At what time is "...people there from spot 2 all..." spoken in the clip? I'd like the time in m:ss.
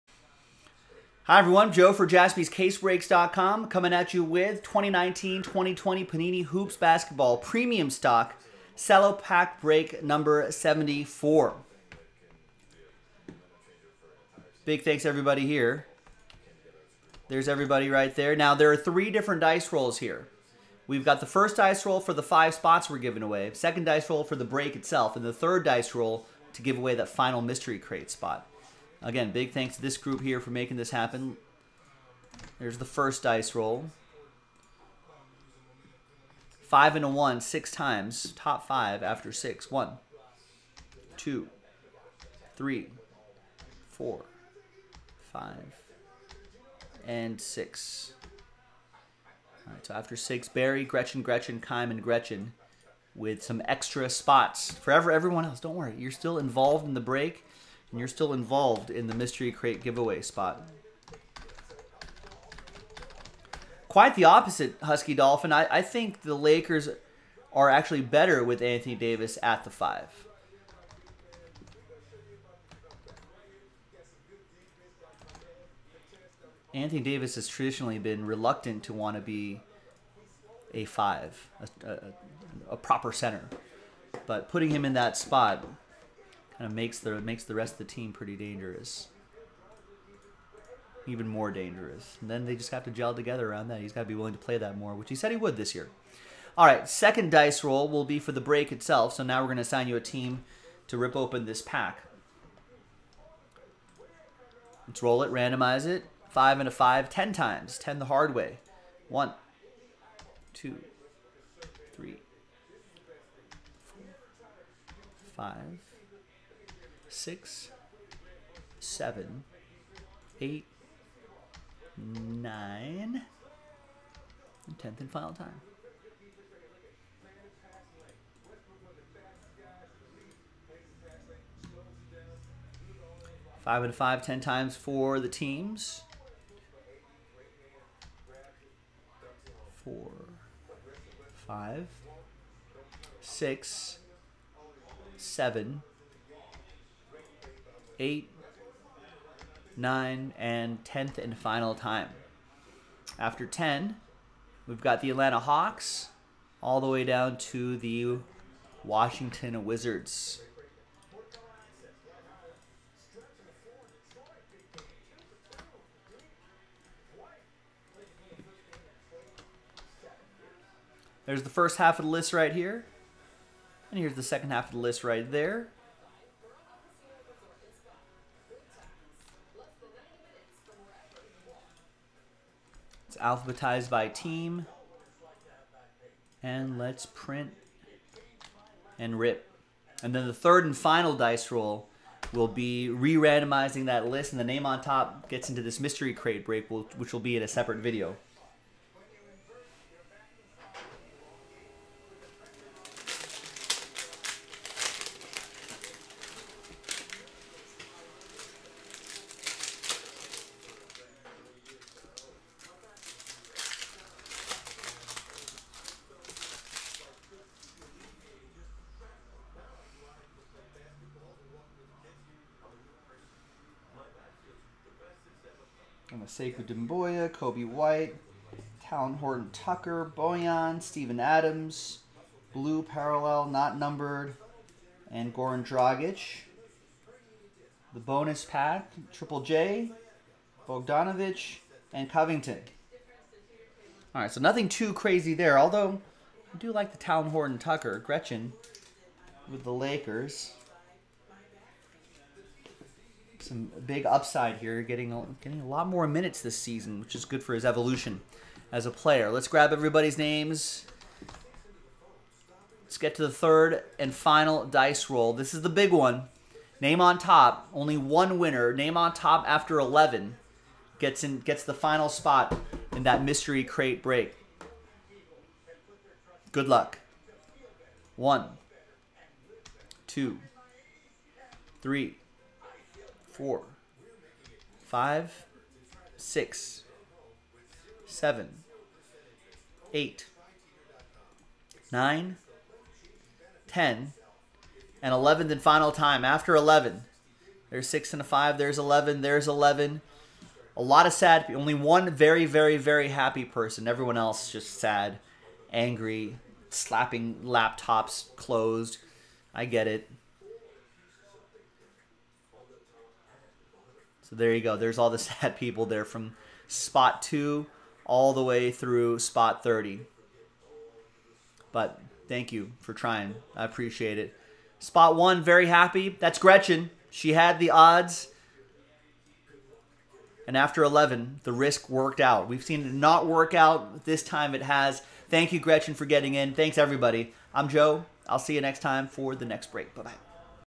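5:15.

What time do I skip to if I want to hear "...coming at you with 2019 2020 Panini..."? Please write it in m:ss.
0:03.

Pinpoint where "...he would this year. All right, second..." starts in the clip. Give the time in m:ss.
1:35.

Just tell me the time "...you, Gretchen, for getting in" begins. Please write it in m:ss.
5:35.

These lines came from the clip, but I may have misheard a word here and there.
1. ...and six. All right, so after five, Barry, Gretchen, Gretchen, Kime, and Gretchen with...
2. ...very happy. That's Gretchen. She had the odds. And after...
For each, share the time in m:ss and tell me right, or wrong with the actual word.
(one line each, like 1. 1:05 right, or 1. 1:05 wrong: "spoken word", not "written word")
1. 0:47 wrong: "six", not "five"
2. 5:25 right.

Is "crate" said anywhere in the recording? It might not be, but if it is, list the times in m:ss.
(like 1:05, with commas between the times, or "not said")
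0:27, 0:59, 3:16, 4:33.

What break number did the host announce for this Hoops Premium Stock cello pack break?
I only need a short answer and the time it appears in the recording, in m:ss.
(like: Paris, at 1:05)
74, at 0:10.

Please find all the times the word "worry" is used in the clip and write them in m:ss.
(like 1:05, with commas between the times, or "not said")
0:55.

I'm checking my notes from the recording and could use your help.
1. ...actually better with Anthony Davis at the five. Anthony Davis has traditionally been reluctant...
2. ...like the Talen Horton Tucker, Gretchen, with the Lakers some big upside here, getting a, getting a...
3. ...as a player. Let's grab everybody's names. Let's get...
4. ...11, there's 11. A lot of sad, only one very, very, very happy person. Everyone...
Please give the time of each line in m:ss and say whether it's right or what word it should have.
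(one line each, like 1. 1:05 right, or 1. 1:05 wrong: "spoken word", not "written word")
1. 1:07 right
2. 4:06 right
3. 4:18 right
4. 4:58 right.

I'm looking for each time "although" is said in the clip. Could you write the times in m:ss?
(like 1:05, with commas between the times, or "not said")
4:05.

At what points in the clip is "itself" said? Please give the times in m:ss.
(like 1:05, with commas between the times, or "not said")
0:24, 1:38.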